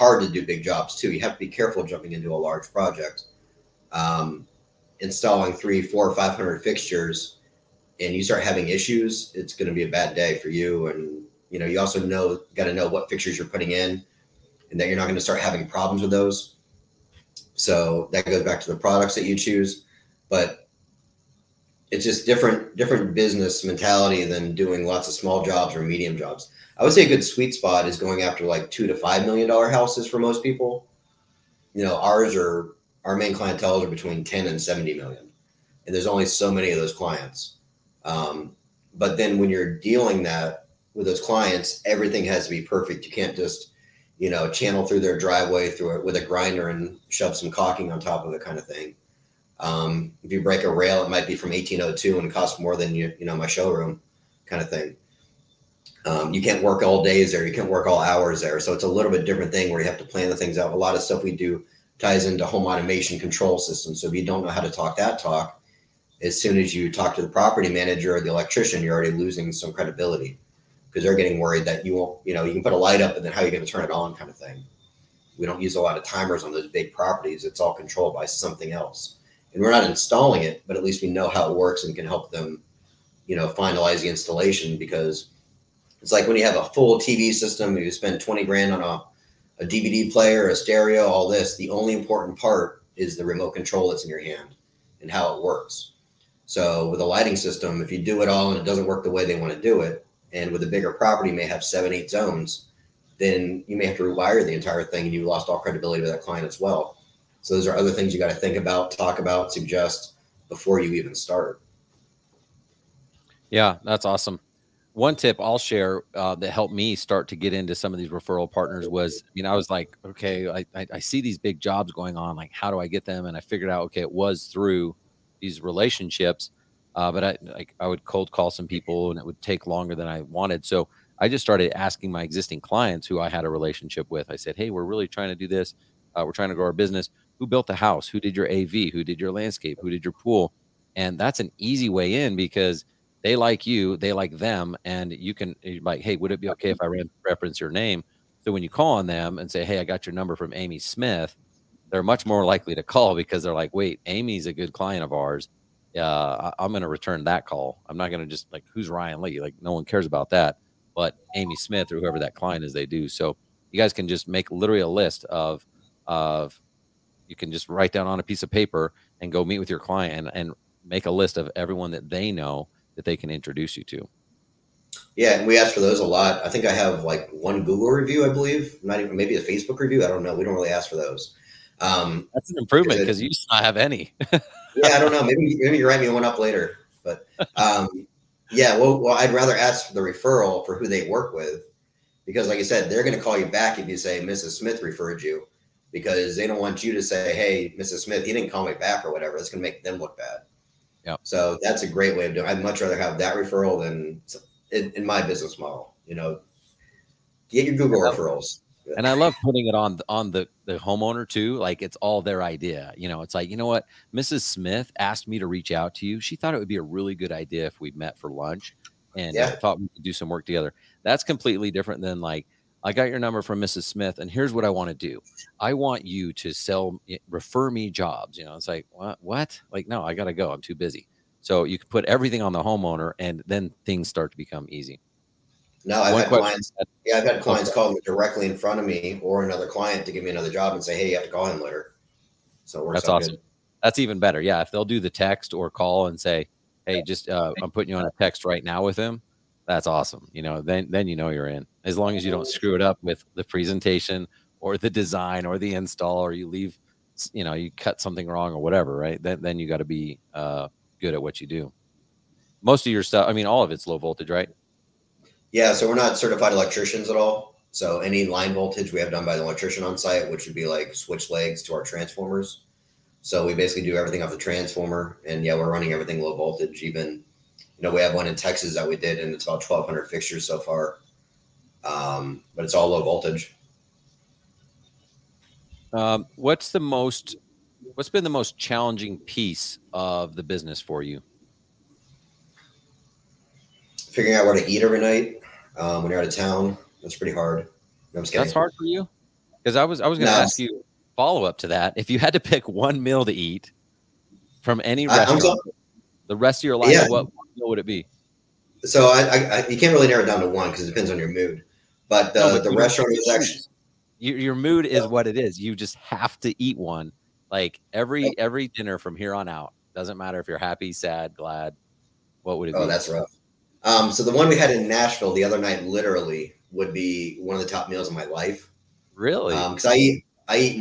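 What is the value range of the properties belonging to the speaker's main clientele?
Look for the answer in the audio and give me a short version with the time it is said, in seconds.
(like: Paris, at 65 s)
10 to 70 million, at 33 s.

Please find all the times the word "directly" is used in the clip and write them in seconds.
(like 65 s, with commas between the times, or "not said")
238 s.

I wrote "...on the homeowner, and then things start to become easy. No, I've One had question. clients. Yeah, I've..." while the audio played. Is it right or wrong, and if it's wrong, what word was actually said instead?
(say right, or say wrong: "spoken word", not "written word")
right.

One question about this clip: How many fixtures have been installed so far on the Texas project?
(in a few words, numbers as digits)
1,200.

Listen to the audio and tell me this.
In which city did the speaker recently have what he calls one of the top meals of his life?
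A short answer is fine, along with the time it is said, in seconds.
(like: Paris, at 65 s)
Nashville, at 324 s.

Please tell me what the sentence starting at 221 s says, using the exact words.
That's completely different than like I got your number from Mrs.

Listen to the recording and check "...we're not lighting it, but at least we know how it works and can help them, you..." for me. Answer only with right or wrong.
wrong.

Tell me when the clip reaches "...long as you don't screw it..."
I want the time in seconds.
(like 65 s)
251 s.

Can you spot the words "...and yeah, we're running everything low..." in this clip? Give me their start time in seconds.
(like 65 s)
275 s.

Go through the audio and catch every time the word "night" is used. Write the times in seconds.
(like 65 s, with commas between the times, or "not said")
295 s, 325 s.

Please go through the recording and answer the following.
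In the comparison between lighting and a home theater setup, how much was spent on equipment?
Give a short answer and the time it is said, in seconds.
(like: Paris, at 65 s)
20 grand, at 88 s.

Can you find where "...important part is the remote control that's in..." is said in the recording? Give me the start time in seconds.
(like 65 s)
91 s.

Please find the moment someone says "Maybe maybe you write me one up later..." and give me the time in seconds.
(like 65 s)
185 s.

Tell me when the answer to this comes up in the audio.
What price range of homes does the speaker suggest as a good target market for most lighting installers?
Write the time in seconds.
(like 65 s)
28 s.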